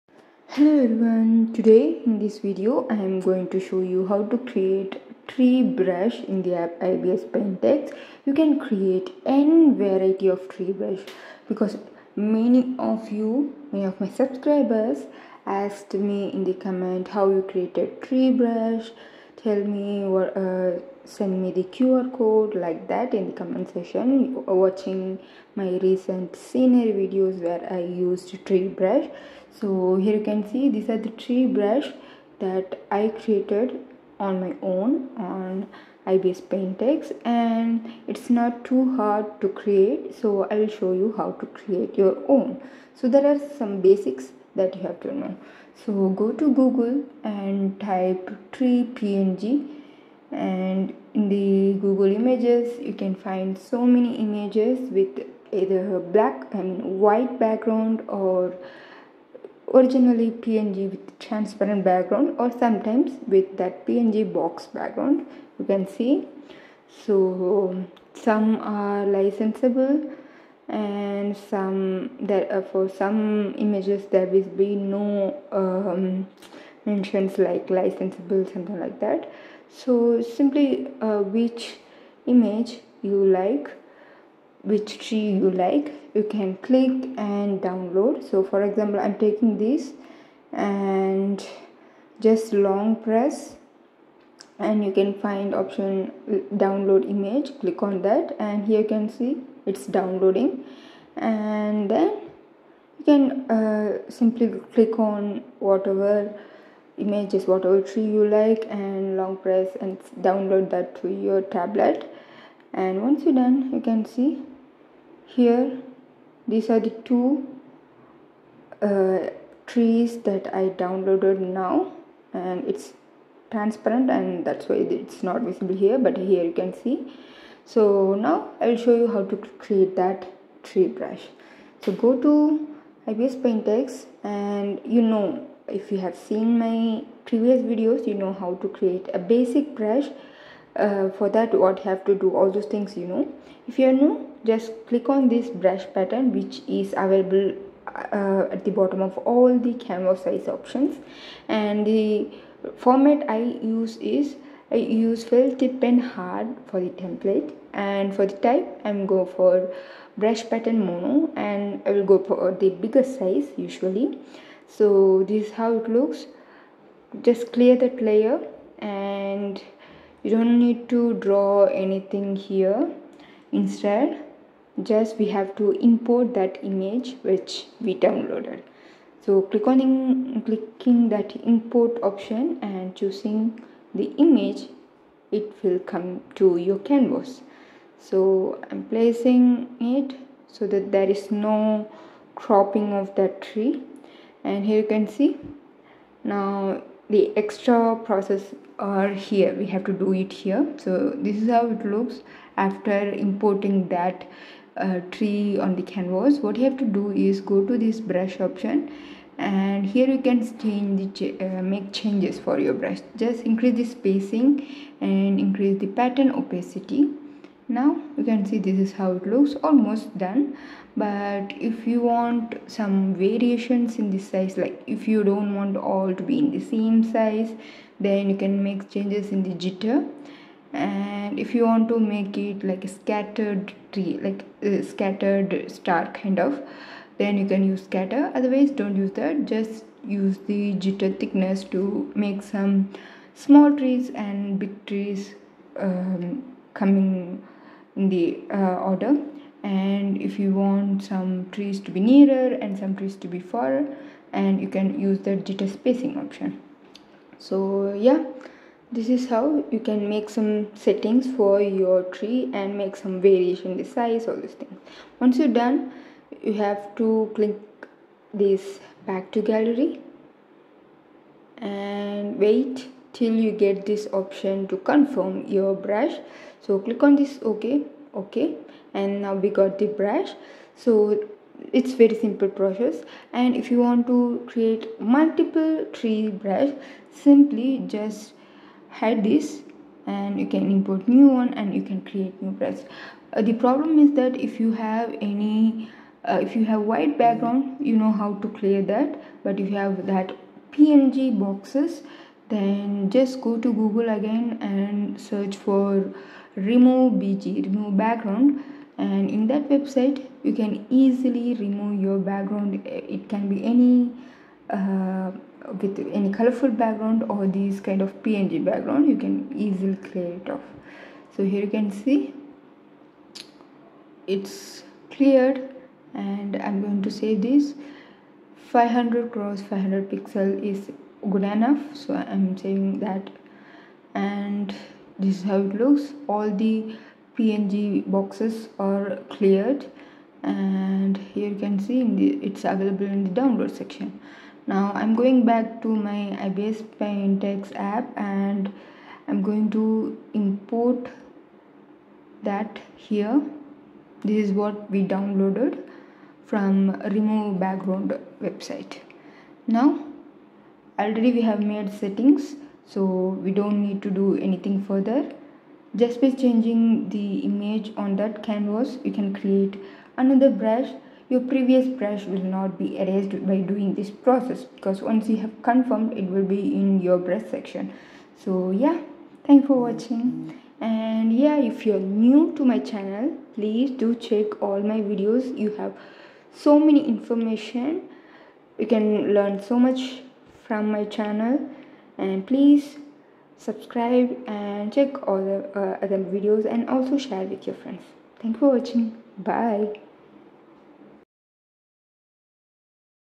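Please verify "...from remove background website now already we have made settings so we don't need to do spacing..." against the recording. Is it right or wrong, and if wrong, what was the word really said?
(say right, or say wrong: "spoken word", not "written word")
wrong: "anything", not "spacing".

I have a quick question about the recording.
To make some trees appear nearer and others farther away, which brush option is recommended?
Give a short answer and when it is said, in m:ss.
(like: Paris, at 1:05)
jitter spacing, at 4:15.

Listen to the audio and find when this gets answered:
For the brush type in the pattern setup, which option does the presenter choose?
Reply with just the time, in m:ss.
2:40.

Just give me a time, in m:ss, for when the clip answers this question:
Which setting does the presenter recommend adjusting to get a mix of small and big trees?
4:00.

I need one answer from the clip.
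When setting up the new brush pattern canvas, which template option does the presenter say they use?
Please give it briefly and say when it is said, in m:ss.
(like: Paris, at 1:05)
fill tip and hard, at 2:35.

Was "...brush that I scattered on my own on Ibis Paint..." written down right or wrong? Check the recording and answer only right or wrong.
wrong.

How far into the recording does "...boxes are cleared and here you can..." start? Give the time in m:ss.
5:38.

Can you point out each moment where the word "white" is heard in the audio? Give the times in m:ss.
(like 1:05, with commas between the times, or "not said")
0:56, 4:56.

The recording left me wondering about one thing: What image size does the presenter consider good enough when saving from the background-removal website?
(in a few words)
500 x 500 pixels.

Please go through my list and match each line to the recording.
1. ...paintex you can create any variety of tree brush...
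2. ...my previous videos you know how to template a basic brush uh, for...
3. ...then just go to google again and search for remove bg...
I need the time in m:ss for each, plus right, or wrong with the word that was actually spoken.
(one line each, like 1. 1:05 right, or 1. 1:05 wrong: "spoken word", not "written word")
1. 0:07 right
2. 2:16 wrong: "create", not "template"
3. 5:02 right.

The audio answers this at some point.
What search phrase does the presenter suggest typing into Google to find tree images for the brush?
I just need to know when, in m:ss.
0:48.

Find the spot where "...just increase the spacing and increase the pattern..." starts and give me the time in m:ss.
3:33.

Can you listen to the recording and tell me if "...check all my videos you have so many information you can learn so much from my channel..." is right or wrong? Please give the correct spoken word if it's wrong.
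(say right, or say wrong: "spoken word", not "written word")
right.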